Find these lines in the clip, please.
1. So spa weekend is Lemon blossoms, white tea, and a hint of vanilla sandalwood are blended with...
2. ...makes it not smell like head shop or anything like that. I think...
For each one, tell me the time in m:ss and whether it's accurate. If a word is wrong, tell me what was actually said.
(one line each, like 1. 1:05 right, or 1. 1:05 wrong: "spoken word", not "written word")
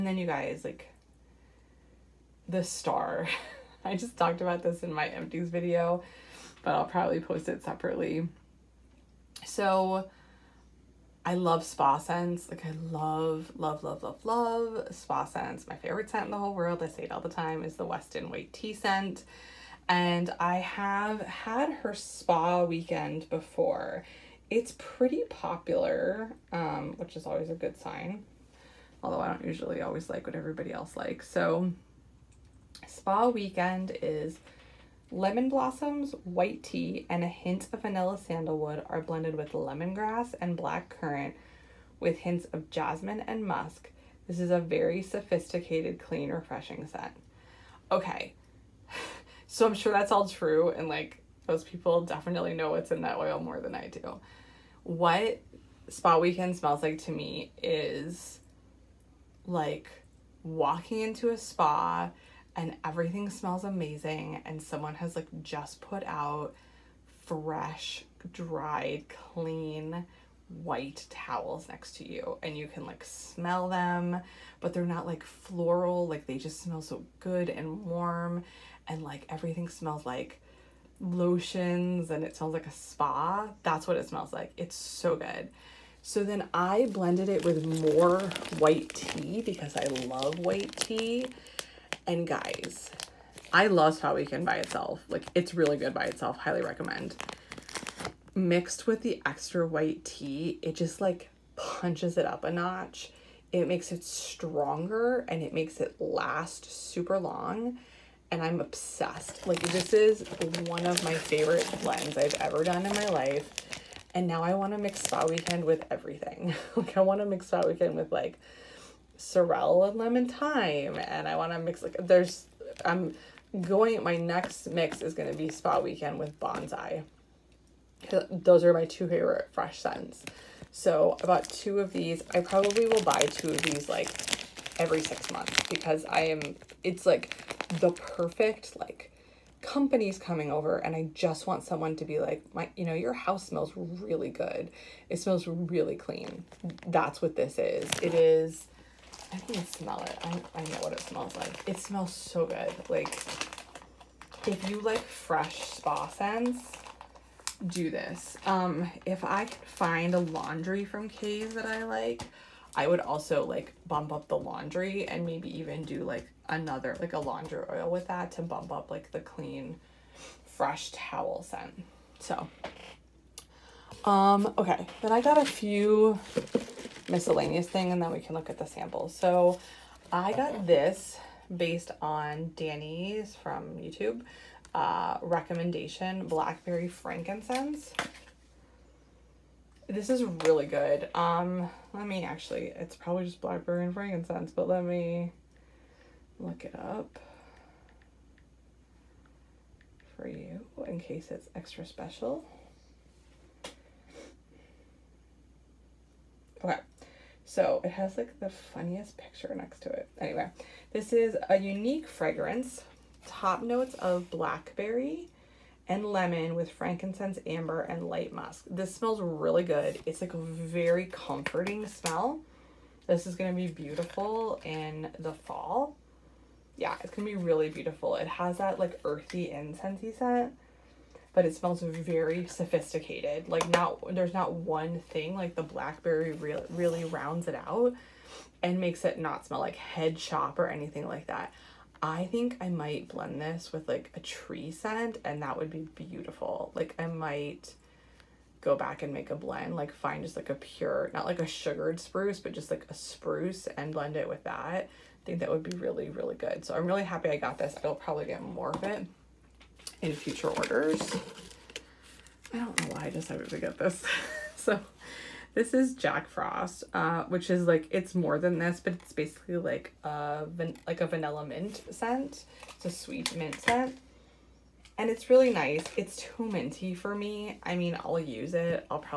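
1. 0:31 right
2. 3:58 right.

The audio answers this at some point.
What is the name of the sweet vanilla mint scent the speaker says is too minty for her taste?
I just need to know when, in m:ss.
4:25.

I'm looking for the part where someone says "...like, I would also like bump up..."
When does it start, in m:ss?
2:41.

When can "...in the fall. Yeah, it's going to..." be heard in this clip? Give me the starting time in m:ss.
3:44.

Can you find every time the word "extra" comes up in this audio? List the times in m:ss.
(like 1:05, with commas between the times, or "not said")
1:39, 3:21.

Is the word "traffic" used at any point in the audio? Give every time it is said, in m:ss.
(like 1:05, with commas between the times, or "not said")
not said.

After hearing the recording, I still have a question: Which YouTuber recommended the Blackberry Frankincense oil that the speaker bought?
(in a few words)
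Danny.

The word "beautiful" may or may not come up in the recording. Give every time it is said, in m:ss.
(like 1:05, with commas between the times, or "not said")
3:43, 3:47, 4:05.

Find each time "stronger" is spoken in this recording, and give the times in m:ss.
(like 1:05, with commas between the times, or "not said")
1:44.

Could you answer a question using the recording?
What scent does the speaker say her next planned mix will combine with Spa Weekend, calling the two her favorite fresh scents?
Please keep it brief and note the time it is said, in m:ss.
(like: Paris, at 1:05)
Bonsai, at 2:06.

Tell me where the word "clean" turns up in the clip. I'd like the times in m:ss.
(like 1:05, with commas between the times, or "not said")
0:45, 1:09, 2:25, 2:49.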